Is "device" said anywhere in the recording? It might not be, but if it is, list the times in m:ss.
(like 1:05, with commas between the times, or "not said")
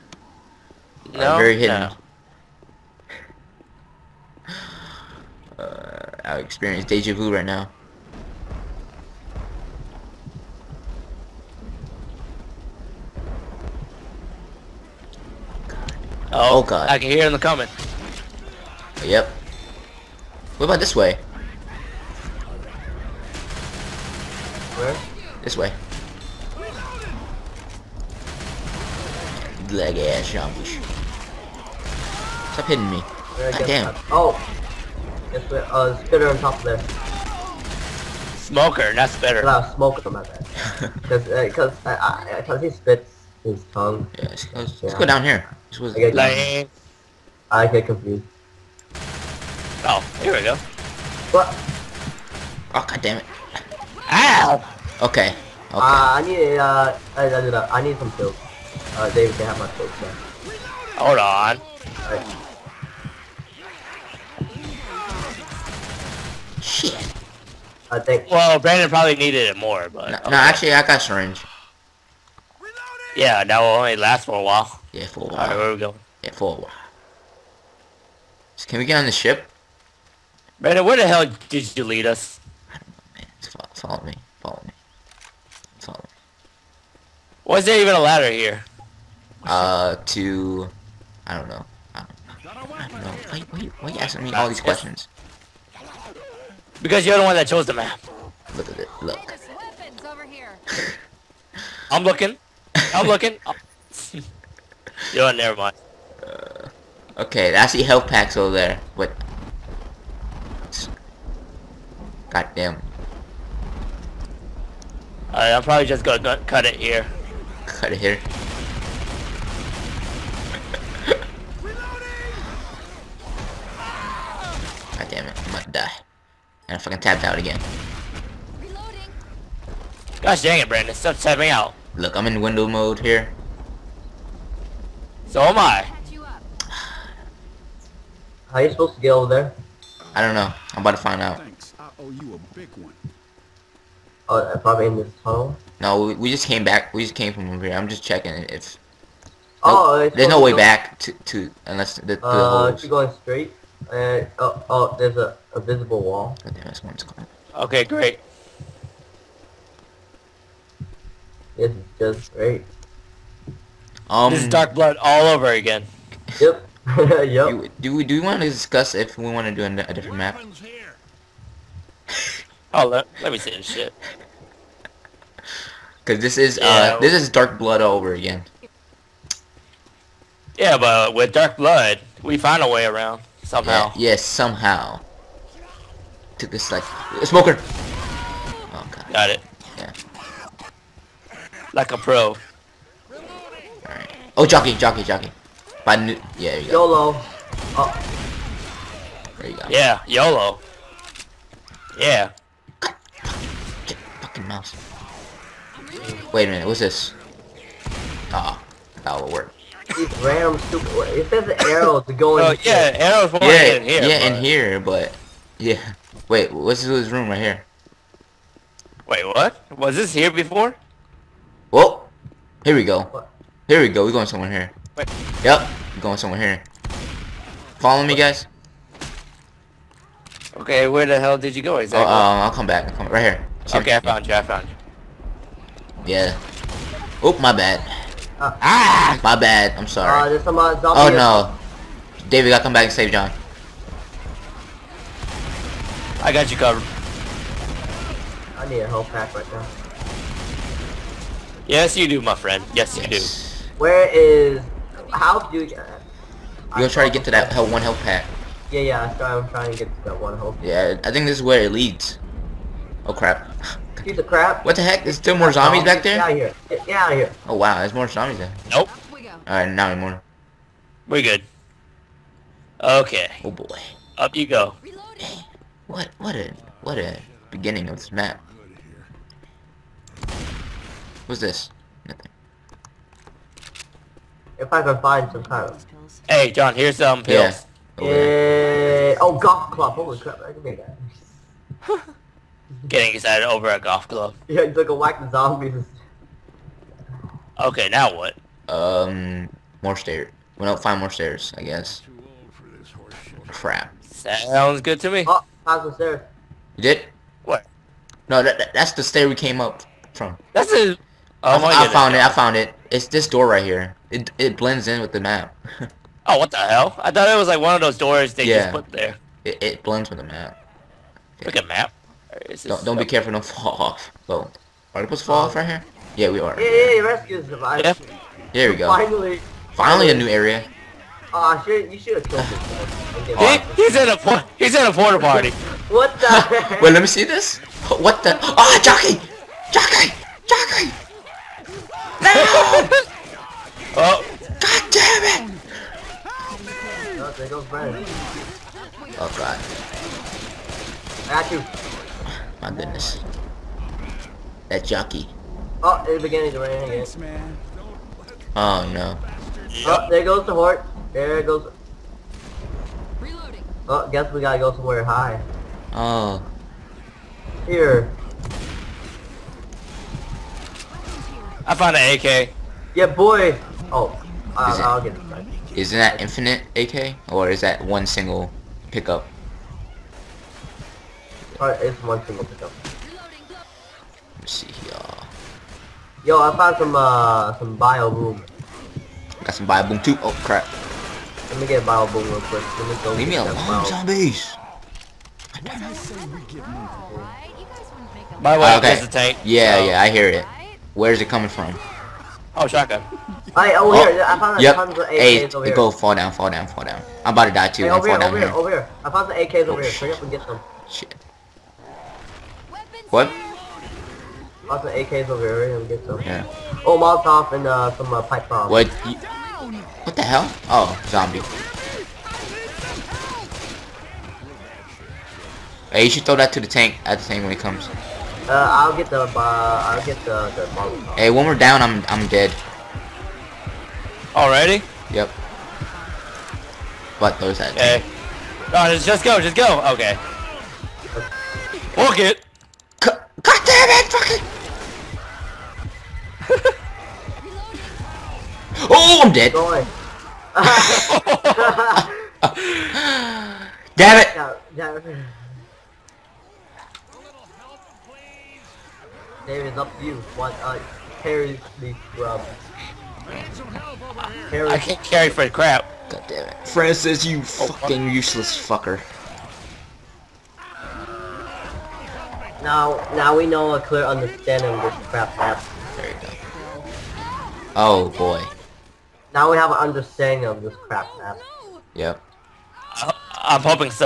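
5:27.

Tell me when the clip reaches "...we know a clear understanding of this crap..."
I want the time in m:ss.
7:53.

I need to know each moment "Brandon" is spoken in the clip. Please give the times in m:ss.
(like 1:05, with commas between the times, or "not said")
1:08, 1:20, 2:10.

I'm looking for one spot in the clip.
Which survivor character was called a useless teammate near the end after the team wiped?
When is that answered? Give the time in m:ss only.
7:46.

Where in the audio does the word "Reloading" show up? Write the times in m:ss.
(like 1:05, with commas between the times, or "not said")
6:03.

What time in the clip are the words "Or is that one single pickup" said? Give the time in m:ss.
6:17.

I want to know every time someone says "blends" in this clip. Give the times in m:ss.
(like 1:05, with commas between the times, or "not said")
5:14, 5:19.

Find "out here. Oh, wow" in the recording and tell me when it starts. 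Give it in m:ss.
4:26.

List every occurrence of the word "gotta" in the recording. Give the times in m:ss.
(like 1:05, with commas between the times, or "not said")
4:02, 6:04.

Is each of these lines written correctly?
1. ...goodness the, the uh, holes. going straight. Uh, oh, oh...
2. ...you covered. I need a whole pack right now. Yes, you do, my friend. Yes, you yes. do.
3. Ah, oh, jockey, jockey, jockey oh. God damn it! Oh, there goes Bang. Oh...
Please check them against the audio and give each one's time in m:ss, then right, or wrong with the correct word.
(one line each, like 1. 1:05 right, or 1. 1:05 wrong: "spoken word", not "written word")
1. 2:31 wrong: "unless", not "goodness"
2. 4:06 right
3. 5:38 right.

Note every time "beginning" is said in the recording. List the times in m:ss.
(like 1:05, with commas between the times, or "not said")
4:37, 5:56.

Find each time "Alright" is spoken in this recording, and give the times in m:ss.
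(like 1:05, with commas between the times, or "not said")
1:15, 1:55, 3:13, 4:29.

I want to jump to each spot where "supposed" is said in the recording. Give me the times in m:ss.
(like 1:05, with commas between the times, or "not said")
2:18, 5:25.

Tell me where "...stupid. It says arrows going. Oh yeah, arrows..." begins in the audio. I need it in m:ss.
3:30.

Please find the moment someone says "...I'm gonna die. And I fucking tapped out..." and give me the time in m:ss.
2:05.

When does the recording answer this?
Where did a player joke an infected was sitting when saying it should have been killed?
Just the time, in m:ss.
5:34.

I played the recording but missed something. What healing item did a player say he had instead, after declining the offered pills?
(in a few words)
Syringe.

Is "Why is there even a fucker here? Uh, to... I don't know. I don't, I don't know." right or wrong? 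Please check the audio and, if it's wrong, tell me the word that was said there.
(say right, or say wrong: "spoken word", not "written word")
wrong: "ladder", not "fucker".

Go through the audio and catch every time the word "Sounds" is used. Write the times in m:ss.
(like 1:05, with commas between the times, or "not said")
5:04.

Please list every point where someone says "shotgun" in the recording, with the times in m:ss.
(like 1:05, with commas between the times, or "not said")
6:42.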